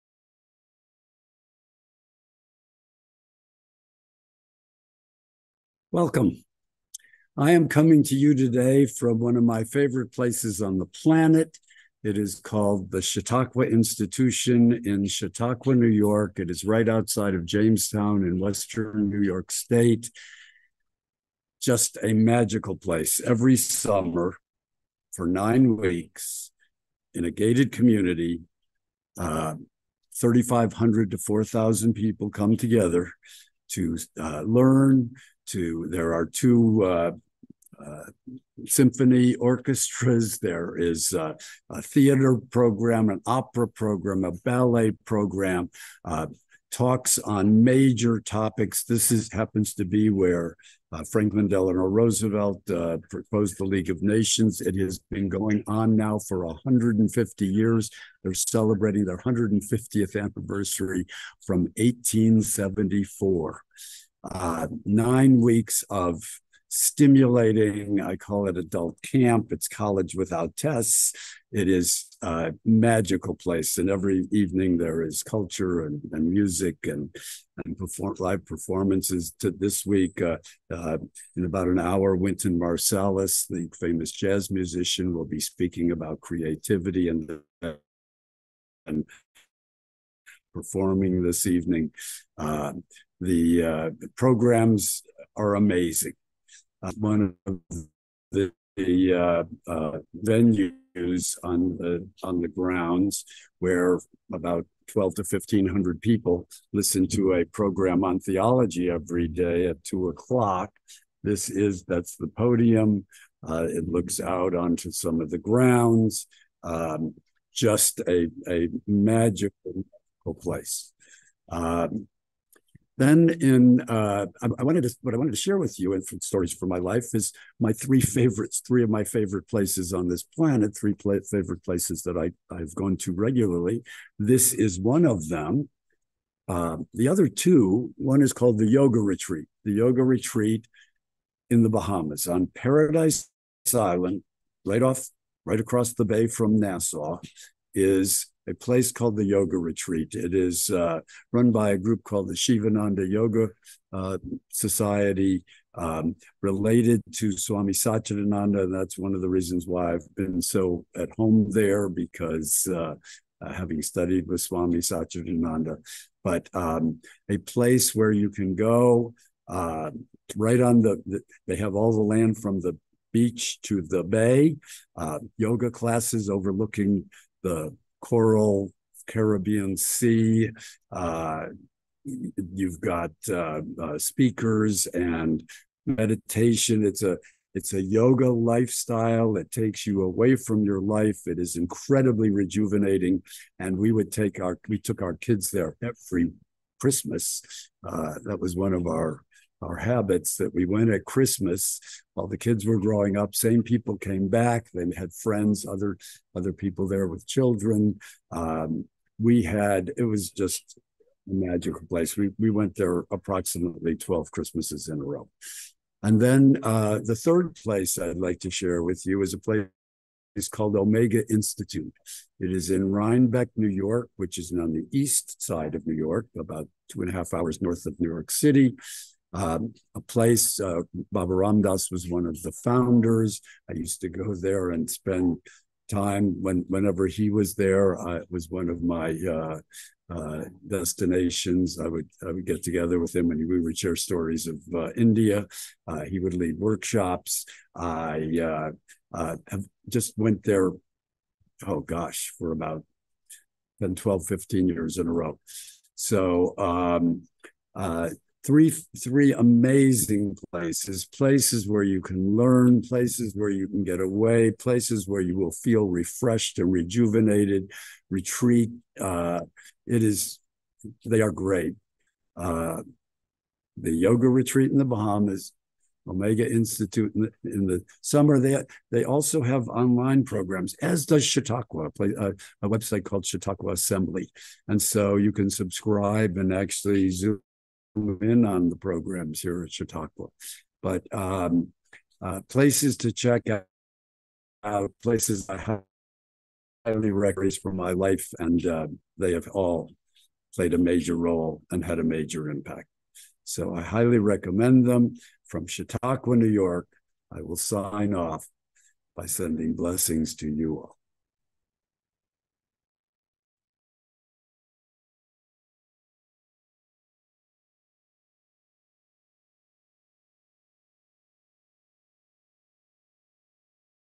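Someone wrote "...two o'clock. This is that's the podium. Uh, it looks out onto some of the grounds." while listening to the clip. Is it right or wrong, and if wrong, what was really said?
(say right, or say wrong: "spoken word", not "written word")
right.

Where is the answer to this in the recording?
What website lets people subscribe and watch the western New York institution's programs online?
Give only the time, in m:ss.
4:43.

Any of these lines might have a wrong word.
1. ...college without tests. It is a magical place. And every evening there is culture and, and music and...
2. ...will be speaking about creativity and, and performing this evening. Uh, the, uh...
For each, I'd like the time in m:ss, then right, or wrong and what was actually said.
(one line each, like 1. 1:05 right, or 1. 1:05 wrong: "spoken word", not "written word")
1. 1:09 right
2. 1:25 right.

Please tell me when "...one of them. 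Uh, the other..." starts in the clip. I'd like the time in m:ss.
2:14.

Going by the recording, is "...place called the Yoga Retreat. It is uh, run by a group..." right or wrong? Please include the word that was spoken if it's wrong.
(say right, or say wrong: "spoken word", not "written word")
right.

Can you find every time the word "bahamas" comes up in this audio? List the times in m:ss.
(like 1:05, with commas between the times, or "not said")
2:21, 4:34.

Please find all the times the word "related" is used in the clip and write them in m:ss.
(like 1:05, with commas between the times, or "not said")
2:36.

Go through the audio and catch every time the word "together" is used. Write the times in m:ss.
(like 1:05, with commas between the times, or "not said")
0:32, 4:02.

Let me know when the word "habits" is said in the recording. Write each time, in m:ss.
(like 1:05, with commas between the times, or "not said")
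3:19.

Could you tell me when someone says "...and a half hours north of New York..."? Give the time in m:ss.
3:47.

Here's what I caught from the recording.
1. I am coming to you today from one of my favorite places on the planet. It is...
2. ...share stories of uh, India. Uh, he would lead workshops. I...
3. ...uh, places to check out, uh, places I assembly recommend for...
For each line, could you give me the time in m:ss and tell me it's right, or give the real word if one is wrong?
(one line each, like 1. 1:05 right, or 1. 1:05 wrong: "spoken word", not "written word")
1. 0:07 right
2. 4:03 right
3. 4:52 wrong: "highly", not "assembly".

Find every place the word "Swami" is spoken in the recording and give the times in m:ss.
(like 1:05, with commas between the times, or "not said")
2:37, 2:44.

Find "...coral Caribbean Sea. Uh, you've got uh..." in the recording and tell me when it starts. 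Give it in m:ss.
2:58.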